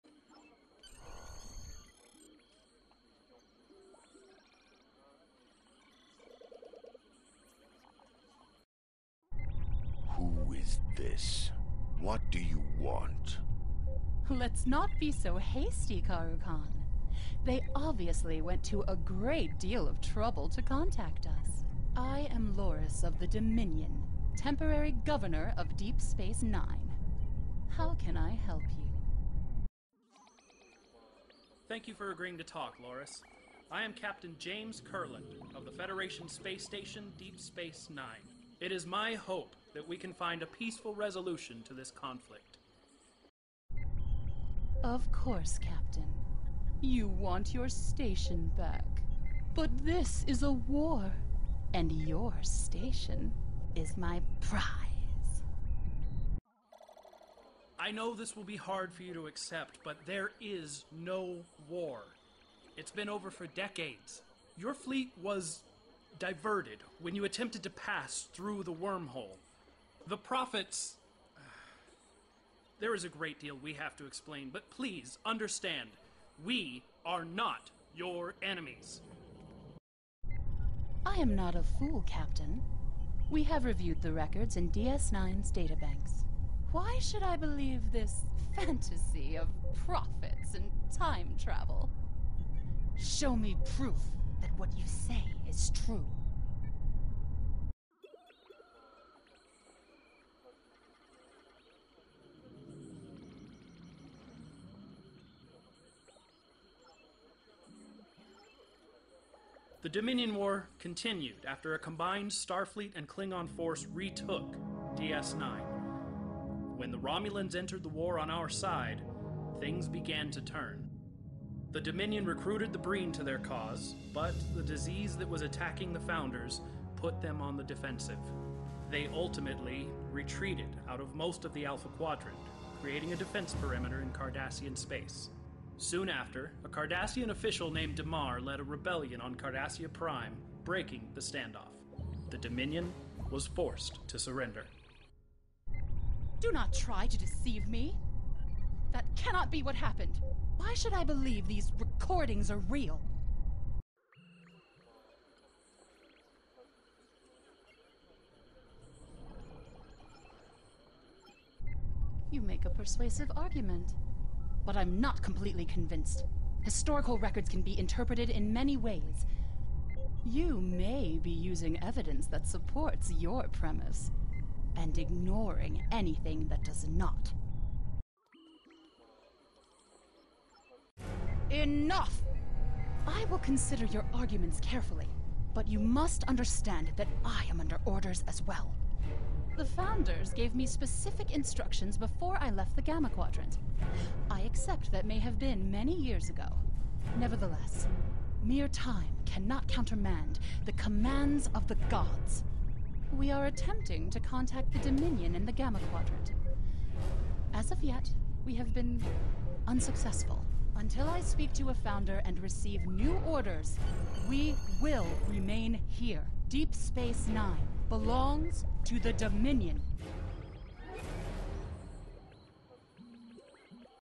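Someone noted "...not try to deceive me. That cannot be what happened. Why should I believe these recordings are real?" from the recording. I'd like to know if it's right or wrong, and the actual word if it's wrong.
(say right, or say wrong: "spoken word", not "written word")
right.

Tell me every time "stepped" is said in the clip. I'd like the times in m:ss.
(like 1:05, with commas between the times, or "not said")
not said.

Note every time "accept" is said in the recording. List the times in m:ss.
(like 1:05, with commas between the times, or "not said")
0:59, 3:14.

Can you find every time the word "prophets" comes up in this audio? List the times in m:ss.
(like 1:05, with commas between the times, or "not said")
1:10, 1:29.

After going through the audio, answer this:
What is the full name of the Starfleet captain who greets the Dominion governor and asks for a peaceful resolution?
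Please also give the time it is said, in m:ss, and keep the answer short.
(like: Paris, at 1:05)
James Kurland, at 0:34.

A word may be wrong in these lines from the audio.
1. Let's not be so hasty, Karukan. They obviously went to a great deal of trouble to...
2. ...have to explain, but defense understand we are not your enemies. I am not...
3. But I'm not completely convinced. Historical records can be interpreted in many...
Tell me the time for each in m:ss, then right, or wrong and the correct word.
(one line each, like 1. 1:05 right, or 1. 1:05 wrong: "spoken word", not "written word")
1. 0:14 right
2. 1:13 wrong: "please", not "defense"
3. 2:44 right.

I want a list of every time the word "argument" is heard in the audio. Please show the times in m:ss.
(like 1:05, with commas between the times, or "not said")
2:43, 3:04.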